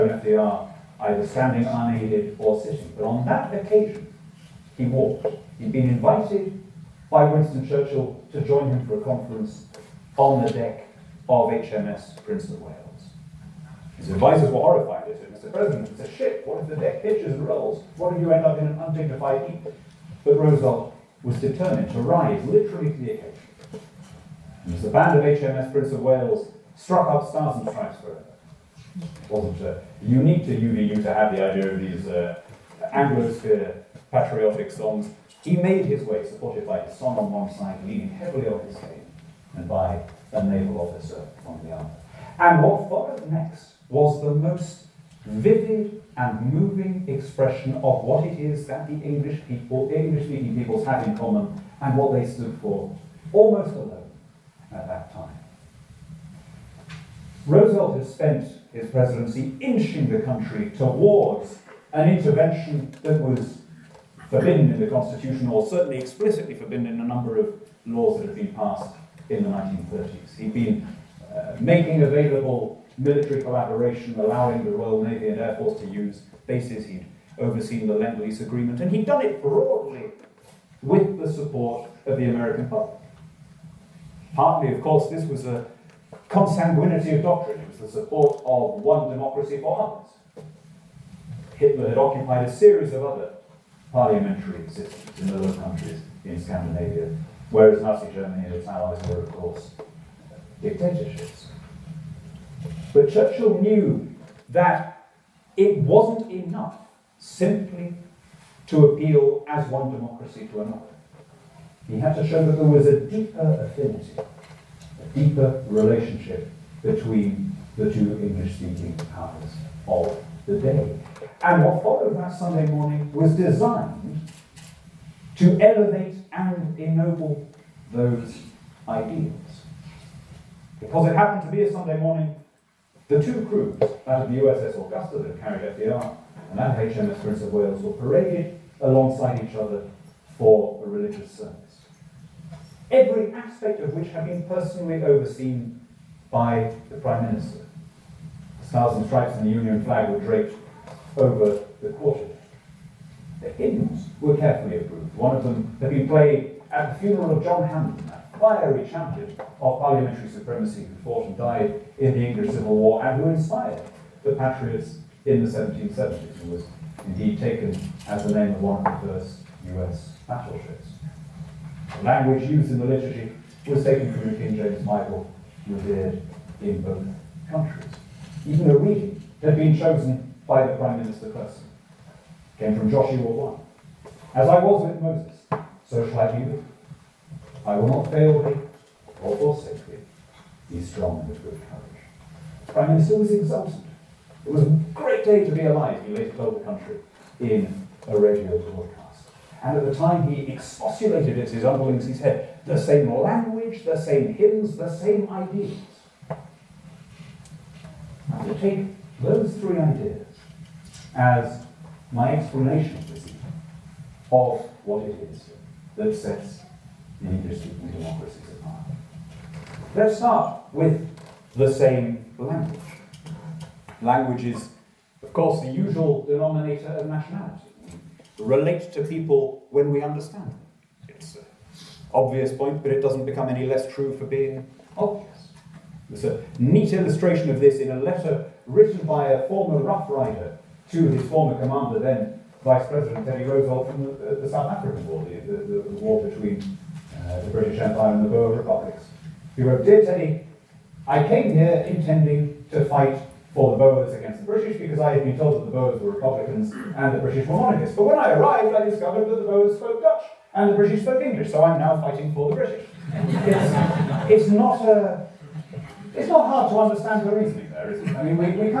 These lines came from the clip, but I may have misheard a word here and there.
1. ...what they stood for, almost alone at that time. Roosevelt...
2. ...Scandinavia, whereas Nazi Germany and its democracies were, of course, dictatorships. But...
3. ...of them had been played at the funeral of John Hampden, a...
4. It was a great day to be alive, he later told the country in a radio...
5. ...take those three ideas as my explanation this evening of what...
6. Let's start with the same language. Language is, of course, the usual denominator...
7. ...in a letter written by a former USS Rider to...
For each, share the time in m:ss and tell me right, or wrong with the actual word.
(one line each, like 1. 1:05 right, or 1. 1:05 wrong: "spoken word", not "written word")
1. 0:51 right
2. 1:36 wrong: "allies", not "democracies"
3. 2:35 right
4. 3:14 right
5. 3:28 right
6. 3:39 right
7. 3:57 wrong: "Rough", not "USS".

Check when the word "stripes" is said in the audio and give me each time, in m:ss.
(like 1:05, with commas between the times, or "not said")
0:27, 2:29.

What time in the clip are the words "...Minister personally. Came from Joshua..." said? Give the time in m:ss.
3:01.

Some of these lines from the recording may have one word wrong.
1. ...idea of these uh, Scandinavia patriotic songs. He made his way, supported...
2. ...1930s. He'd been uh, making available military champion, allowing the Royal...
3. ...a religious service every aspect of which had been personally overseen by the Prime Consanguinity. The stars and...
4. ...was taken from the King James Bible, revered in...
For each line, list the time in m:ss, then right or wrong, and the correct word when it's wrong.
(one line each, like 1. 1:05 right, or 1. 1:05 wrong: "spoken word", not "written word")
1. 0:31 wrong: "Anglosphere", not "Scandinavia"
2. 1:09 wrong: "collaboration", not "champion"
3. 2:20 wrong: "Minister", not "Consanguinity"
4. 2:53 right.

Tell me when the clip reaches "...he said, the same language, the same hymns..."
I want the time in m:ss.
3:22.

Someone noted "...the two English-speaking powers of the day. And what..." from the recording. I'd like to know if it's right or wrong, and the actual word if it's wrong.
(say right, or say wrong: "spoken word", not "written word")
right.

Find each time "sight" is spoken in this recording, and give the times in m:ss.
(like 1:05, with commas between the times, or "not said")
not said.